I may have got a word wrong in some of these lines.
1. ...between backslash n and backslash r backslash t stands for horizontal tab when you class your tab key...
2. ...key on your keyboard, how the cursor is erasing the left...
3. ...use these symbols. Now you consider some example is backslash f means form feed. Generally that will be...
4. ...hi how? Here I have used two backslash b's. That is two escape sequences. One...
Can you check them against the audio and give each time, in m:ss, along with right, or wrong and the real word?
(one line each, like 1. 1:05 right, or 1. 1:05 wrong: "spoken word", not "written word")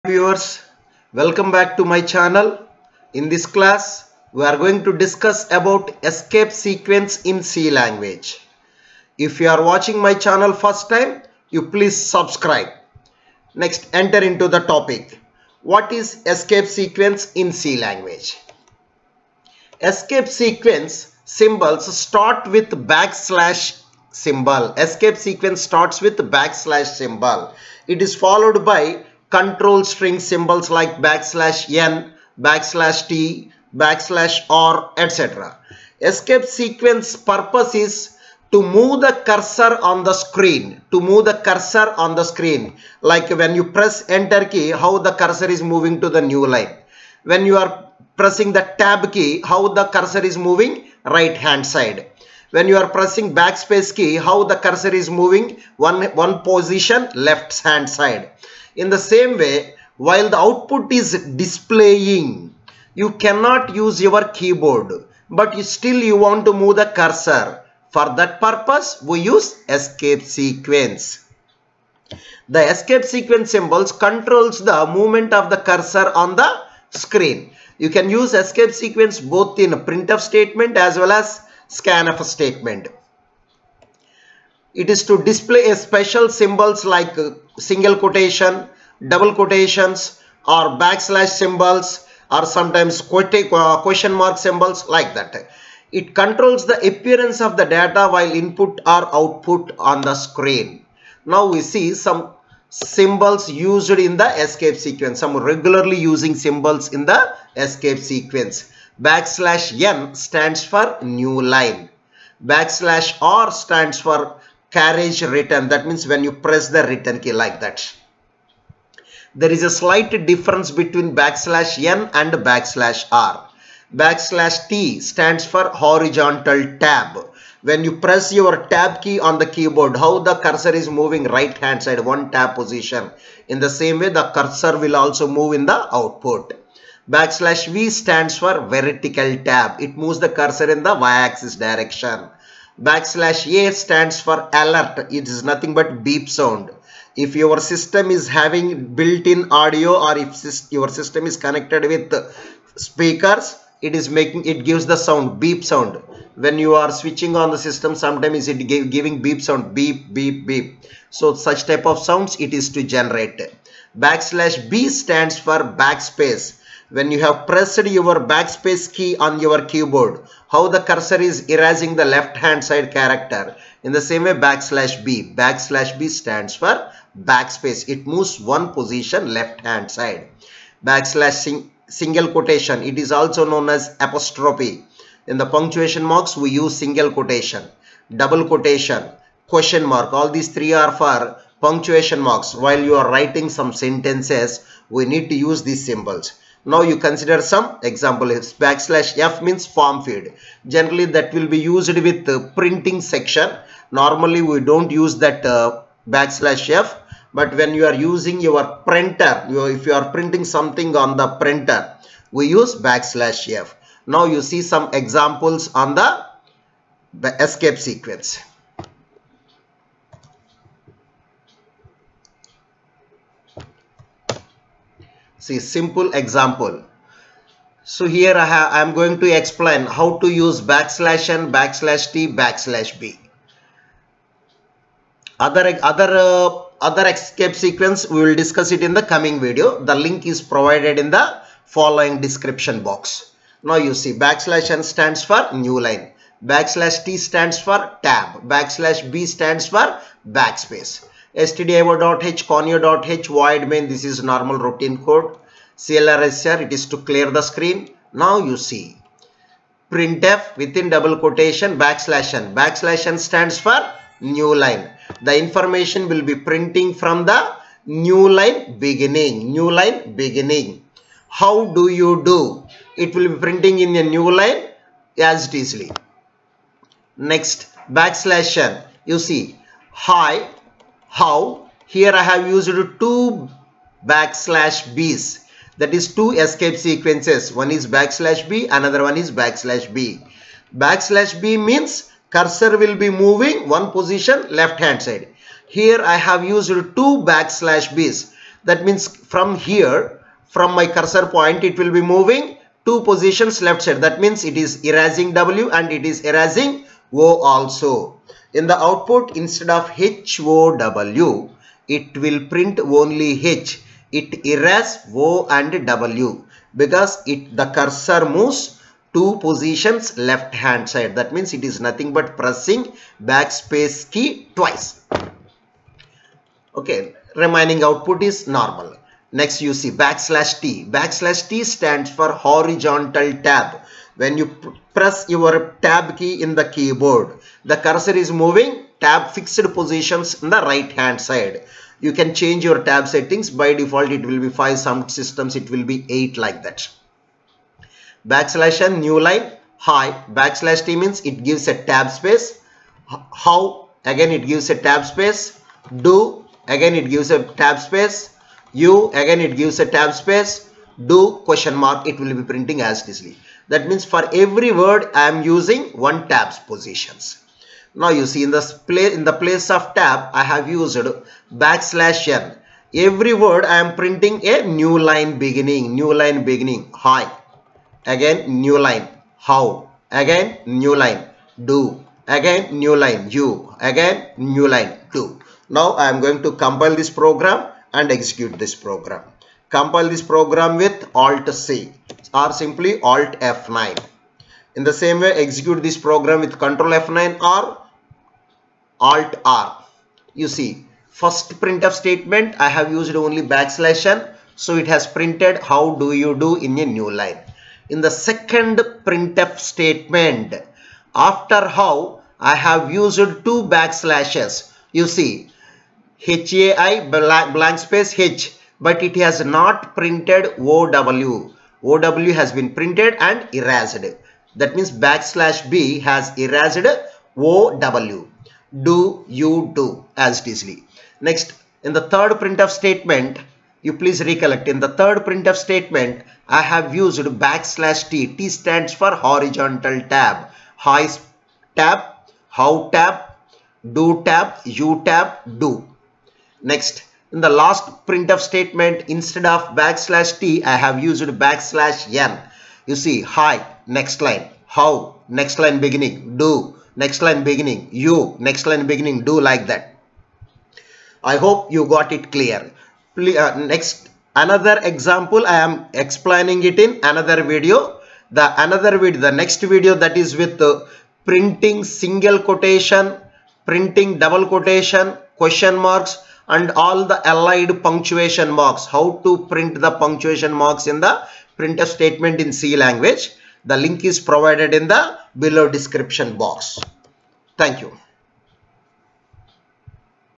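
1. 2:00 wrong: "press", not "class"
2. 2:48 right
3. 3:15 right
4. 4:39 right.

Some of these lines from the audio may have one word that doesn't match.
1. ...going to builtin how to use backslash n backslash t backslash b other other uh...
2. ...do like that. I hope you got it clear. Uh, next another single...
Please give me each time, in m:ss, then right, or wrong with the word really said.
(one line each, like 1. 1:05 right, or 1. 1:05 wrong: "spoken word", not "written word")
1. 3:48 wrong: "explain", not "builtin"
2. 7:39 wrong: "example", not "single".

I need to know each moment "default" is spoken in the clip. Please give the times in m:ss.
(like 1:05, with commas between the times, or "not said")
5:43.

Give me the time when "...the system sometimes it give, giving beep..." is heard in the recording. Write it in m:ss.
2:37.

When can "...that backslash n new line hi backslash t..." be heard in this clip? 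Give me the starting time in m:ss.
5:46.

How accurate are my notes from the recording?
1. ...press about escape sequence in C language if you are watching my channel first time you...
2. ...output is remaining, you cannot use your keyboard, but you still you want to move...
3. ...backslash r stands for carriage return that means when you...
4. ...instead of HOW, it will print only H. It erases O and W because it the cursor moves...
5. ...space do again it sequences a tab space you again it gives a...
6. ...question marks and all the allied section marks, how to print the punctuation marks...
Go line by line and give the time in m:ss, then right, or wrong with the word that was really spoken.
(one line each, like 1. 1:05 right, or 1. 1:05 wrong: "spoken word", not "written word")
1. 0:05 wrong: "discuss", not "press"
2. 1:00 wrong: "displaying", not "remaining"
3. 1:52 right
4. 5:09 right
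5. 5:55 wrong: "gives", not "sequences"
6. 7:55 wrong: "punctuation", not "section".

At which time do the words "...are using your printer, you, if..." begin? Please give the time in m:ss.
3:27.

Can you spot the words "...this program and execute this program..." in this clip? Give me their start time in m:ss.
6:26.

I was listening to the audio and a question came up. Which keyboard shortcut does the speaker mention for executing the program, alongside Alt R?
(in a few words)
Control F9.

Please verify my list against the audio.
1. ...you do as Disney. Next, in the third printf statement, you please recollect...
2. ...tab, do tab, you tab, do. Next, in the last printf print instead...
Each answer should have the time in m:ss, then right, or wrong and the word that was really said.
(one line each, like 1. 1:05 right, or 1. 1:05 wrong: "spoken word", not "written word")
1. 7:09 right
2. 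7:22 wrong: "statement", not "print".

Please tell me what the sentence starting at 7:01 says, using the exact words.
OW has been printed and erased.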